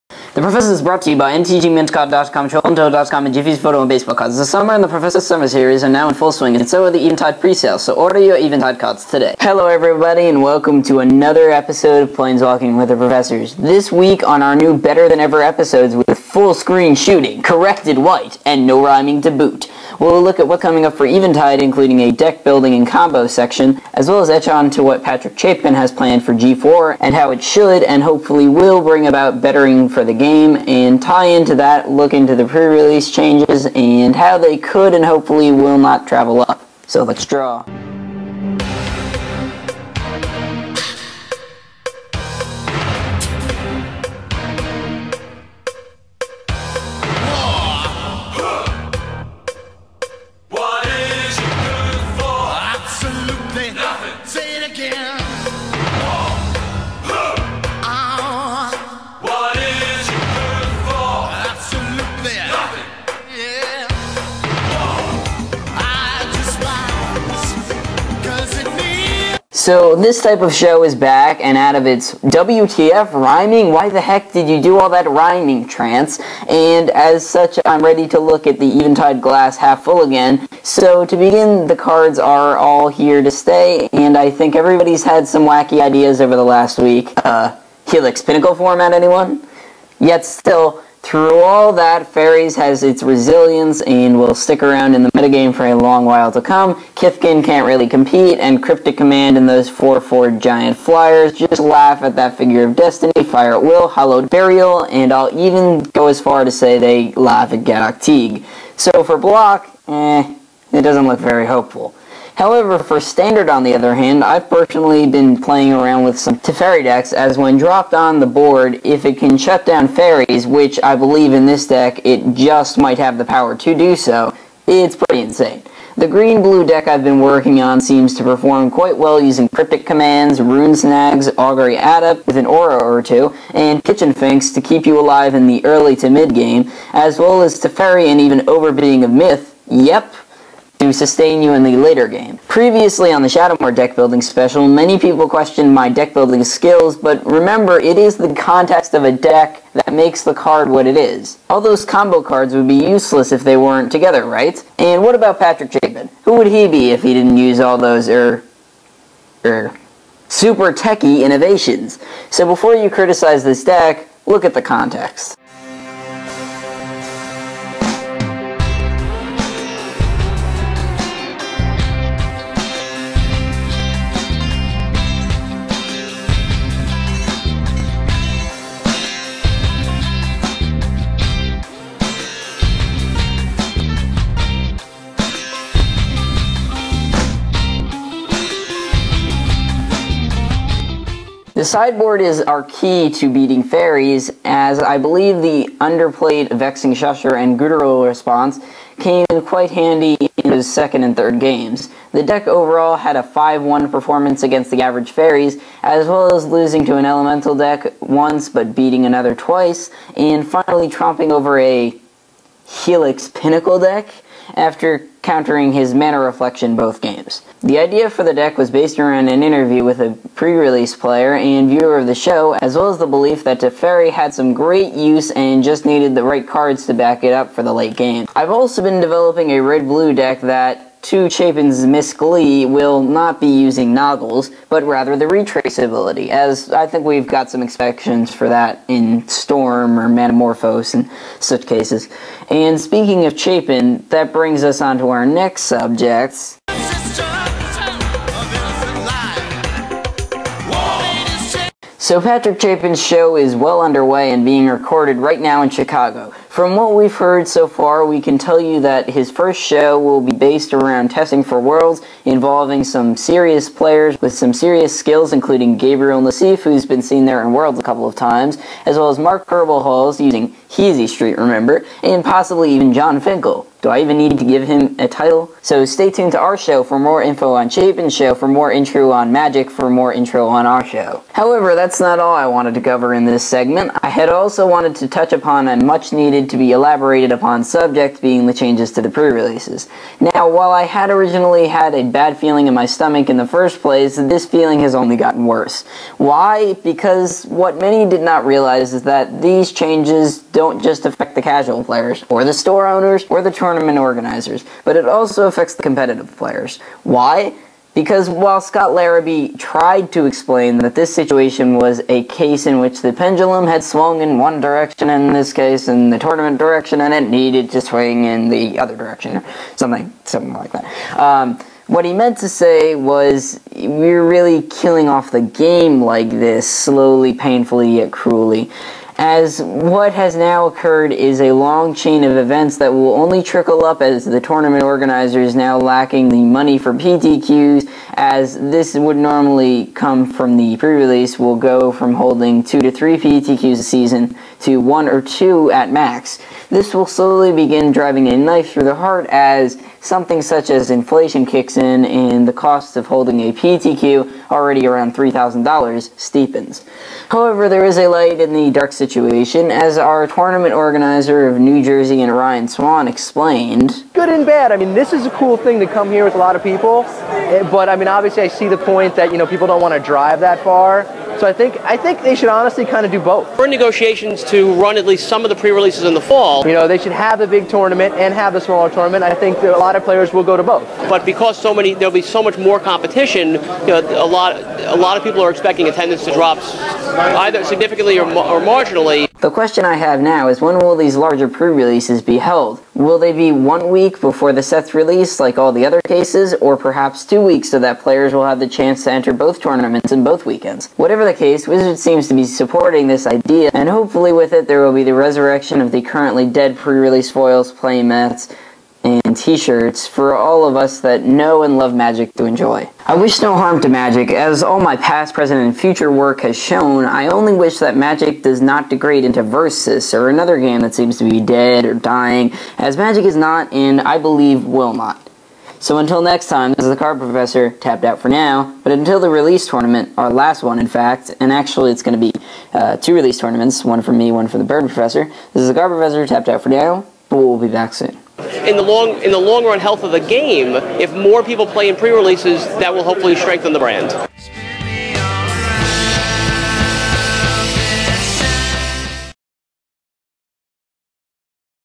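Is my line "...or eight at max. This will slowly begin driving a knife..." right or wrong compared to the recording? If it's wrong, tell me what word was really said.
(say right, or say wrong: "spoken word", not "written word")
wrong: "two", not "eight".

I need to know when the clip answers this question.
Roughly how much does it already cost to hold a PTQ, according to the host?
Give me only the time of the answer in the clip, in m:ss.
5:55.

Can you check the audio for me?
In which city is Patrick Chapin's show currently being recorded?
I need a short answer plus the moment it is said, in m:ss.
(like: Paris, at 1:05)
Chicago, at 4:15.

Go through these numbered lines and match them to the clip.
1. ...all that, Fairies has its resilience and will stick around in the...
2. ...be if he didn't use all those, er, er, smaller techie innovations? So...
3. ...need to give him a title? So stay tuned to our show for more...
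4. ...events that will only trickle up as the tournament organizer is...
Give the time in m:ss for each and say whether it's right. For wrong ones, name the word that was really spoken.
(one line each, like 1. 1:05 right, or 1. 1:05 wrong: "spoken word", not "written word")
1. 1:31 right
2. 2:36 wrong: "super", not "smaller"
3. 4:34 right
4. 5:32 right.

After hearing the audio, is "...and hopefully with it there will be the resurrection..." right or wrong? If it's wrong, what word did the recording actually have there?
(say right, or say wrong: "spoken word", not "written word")
right.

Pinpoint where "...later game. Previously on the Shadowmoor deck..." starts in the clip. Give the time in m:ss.
2:21.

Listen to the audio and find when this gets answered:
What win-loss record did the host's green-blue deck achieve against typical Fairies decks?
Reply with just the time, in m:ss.
3:23.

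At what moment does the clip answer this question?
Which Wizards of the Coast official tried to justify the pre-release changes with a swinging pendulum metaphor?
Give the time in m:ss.
5:08.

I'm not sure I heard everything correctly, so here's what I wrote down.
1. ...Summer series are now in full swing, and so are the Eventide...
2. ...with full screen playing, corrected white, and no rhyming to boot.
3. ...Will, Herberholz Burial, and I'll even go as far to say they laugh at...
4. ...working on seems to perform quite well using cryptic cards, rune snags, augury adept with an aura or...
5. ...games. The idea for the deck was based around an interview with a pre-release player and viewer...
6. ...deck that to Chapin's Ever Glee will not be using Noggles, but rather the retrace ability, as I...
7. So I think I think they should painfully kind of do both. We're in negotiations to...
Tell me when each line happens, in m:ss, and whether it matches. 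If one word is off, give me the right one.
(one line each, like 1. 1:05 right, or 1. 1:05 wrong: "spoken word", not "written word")
1. 0:05 right
2. 0:15 wrong: "shooting", not "playing"
3. 1:43 wrong: "Hallowed", not "Herberholz"
4. 2:07 wrong: "commands", not "cards"
5. 3:37 right
6. 3:50 wrong: "Miss", not "Ever"
7. 6:11 wrong: "honestly", not "painfully".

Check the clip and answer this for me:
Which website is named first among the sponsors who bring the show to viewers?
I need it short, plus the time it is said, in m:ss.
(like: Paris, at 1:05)
mtgmintcard.com, at 0:01.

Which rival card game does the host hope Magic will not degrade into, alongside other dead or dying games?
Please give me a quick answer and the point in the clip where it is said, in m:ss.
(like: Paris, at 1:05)
Versus, at 6:59.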